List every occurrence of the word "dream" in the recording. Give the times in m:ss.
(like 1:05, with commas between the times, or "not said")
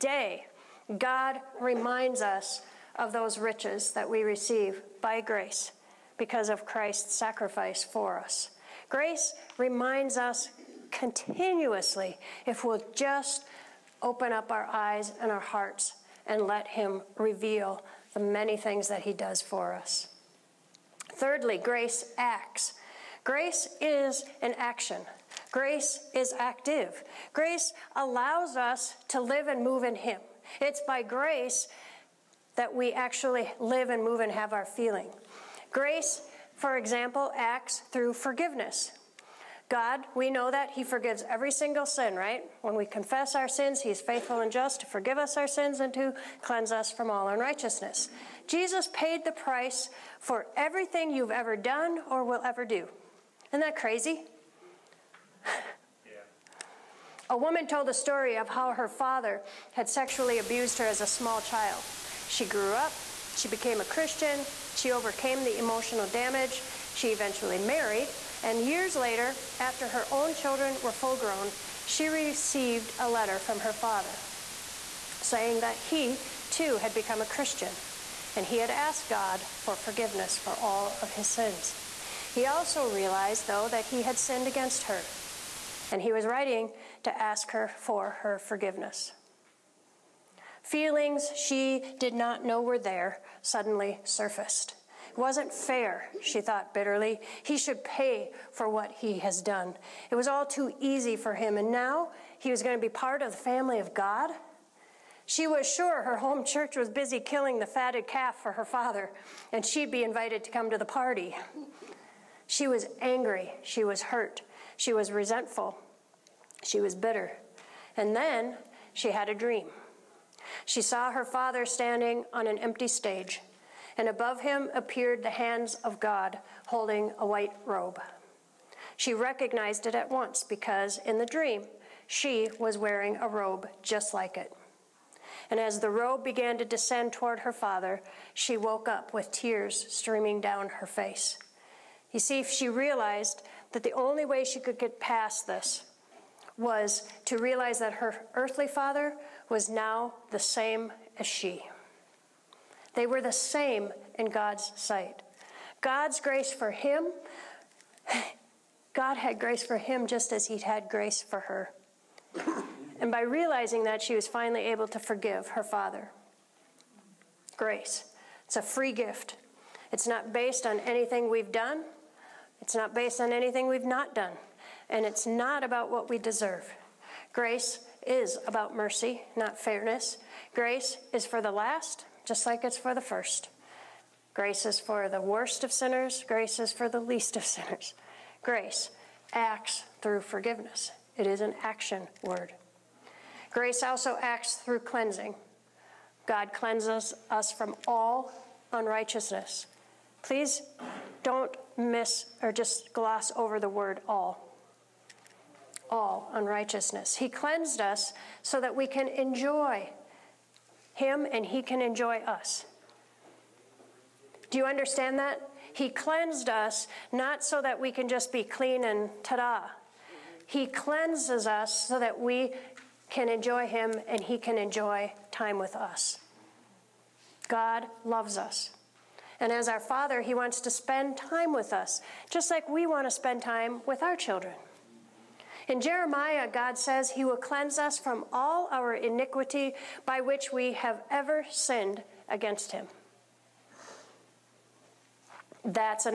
1:59, 2:11.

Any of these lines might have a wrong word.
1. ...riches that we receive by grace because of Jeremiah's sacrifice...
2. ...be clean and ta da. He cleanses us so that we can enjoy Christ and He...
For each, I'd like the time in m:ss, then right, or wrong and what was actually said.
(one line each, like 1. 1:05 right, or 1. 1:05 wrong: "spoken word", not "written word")
1. 0:03 wrong: "Christ", not "Jeremiah"
2. 3:38 wrong: "Him", not "Christ".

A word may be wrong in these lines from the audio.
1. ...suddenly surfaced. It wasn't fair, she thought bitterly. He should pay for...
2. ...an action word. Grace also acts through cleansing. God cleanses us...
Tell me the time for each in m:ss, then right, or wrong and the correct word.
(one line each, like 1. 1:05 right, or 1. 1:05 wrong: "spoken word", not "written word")
1. 1:33 right
2. 3:11 right.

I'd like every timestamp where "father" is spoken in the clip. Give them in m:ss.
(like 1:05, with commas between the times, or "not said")
0:58, 1:13, 1:48, 2:01, 2:17, 2:28, 2:45, 3:49.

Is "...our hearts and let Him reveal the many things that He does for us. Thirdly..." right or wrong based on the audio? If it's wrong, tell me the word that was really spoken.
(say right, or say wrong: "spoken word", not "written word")
right.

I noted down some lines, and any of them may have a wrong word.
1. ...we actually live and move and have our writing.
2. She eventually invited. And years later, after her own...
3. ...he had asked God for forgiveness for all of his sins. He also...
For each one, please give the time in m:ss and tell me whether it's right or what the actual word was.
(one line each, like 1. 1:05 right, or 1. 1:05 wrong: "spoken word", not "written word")
1. 0:32 wrong: "feeling", not "writing"
2. 1:06 wrong: "married", not "invited"
3. 1:18 right.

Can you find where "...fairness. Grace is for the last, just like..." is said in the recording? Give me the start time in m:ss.
2:59.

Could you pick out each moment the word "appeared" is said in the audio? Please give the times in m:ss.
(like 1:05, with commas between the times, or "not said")
2:04.